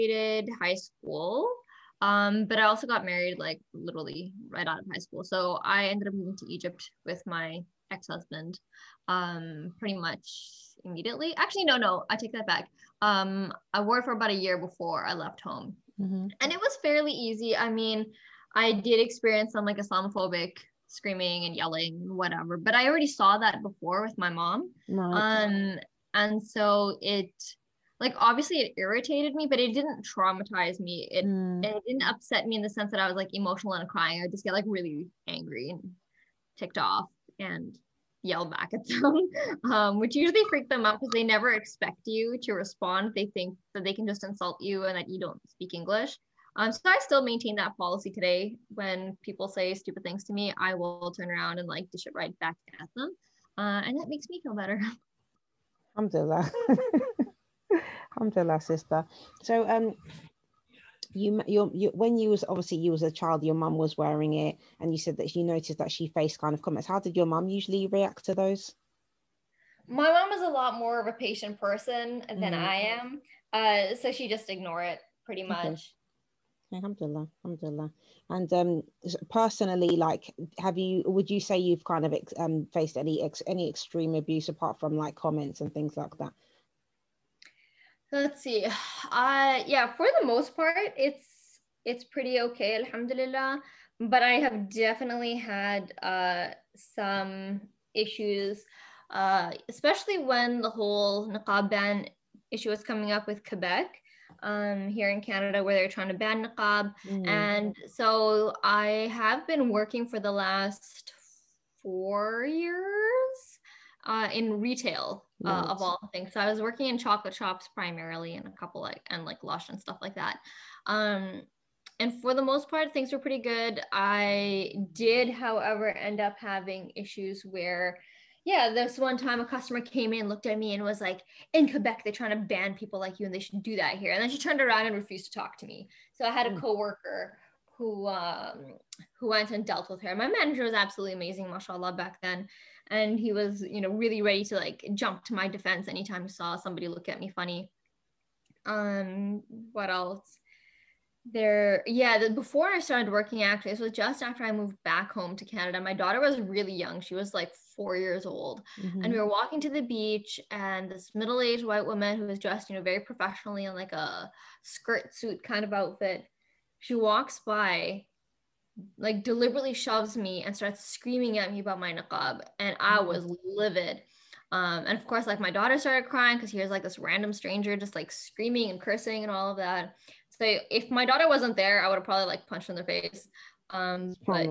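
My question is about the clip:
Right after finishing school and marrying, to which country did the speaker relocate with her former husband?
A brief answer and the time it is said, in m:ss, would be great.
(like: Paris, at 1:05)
Egypt, at 0:06.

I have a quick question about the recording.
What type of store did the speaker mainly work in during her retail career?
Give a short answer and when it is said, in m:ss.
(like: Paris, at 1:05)
Chocolate shops, at 1:56.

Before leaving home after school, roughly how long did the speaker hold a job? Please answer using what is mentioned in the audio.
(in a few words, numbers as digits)
About a year.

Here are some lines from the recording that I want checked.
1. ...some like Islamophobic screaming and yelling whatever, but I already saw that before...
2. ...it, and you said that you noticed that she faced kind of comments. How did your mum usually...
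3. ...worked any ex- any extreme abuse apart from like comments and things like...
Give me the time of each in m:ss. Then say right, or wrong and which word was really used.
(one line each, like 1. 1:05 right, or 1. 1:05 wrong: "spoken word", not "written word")
1. 0:19 right
2. 1:04 right
3. 1:22 wrong: "faced", not "worked".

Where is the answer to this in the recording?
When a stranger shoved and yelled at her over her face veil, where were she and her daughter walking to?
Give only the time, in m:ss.
2:39.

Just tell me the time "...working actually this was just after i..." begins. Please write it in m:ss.
2:33.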